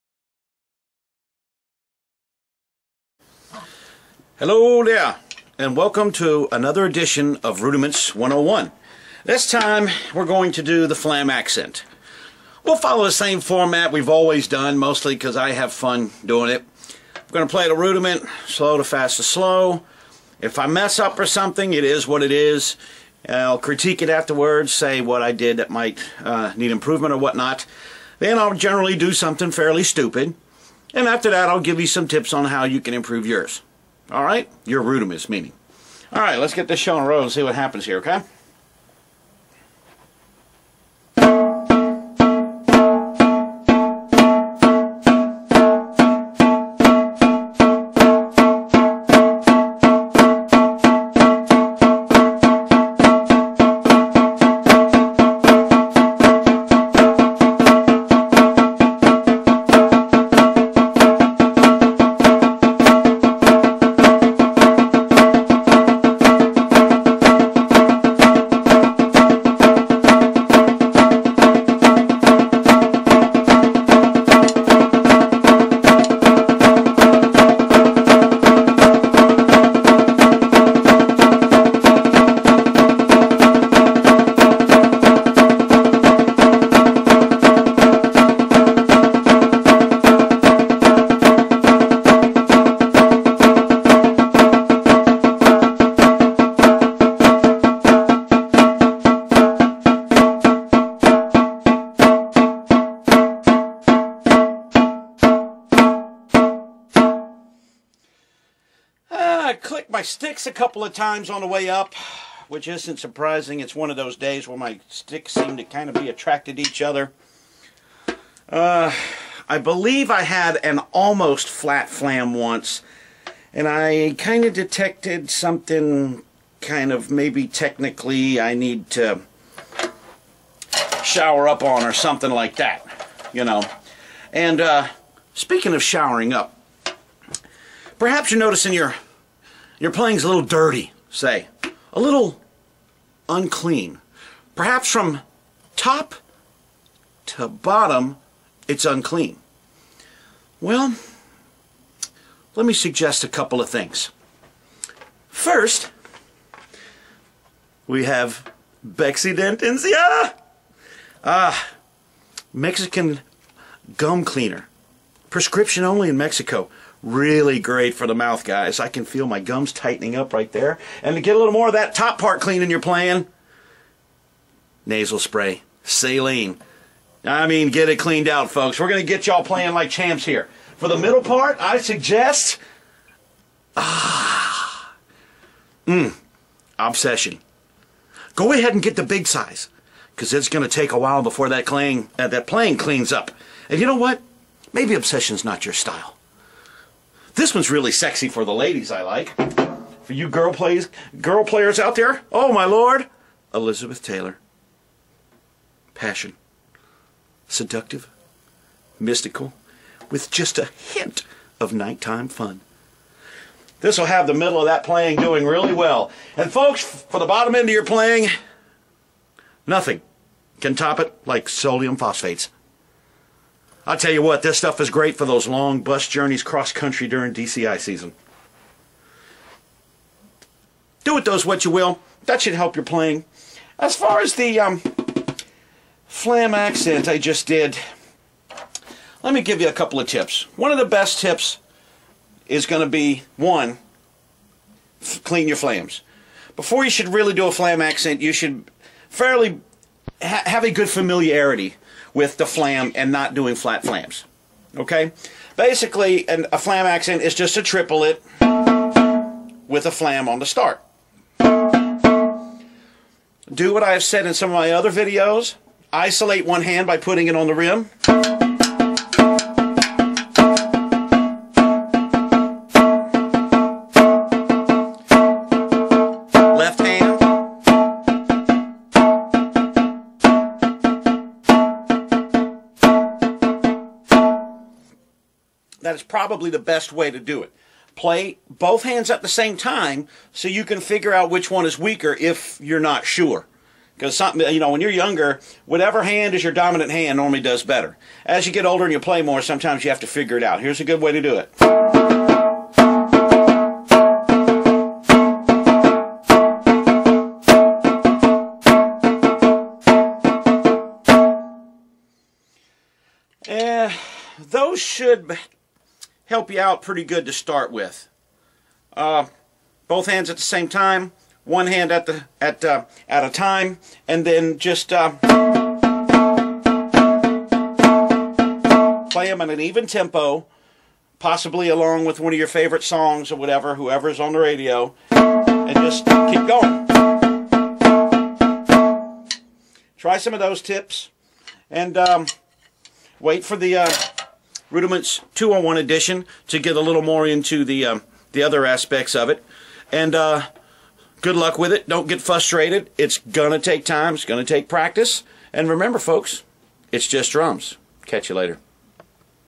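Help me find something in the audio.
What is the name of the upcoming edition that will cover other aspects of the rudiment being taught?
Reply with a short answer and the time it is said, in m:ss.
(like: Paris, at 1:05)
Rudiments 201, at 5:44.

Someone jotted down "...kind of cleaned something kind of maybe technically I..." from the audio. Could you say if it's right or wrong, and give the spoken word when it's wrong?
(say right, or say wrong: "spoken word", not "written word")
wrong: "detected", not "cleaned".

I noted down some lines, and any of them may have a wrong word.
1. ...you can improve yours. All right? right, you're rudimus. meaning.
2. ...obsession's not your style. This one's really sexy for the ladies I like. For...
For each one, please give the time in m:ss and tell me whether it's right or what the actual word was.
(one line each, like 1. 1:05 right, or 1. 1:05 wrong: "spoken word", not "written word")
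1. 0:32 right
2. 3:14 right.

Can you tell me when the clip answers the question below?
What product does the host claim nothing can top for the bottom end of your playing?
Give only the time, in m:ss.
3:41.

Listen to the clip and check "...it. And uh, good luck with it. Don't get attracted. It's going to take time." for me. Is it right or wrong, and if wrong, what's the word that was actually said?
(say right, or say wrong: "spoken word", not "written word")
wrong: "frustrated", not "attracted".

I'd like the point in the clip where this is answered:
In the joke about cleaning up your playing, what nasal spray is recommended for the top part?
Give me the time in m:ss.
2:55.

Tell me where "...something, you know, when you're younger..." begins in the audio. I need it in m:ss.
4:54.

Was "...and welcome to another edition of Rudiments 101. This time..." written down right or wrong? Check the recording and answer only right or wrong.
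right.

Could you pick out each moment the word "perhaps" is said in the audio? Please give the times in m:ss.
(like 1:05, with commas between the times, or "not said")
2:17, 2:24.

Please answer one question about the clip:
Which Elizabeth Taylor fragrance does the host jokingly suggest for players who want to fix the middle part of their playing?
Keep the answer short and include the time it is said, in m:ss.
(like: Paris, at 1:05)
Passion, at 3:25.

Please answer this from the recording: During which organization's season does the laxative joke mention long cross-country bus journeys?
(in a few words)
DCI.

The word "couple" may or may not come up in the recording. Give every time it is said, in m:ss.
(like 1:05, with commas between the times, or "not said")
1:50, 2:33, 3:59.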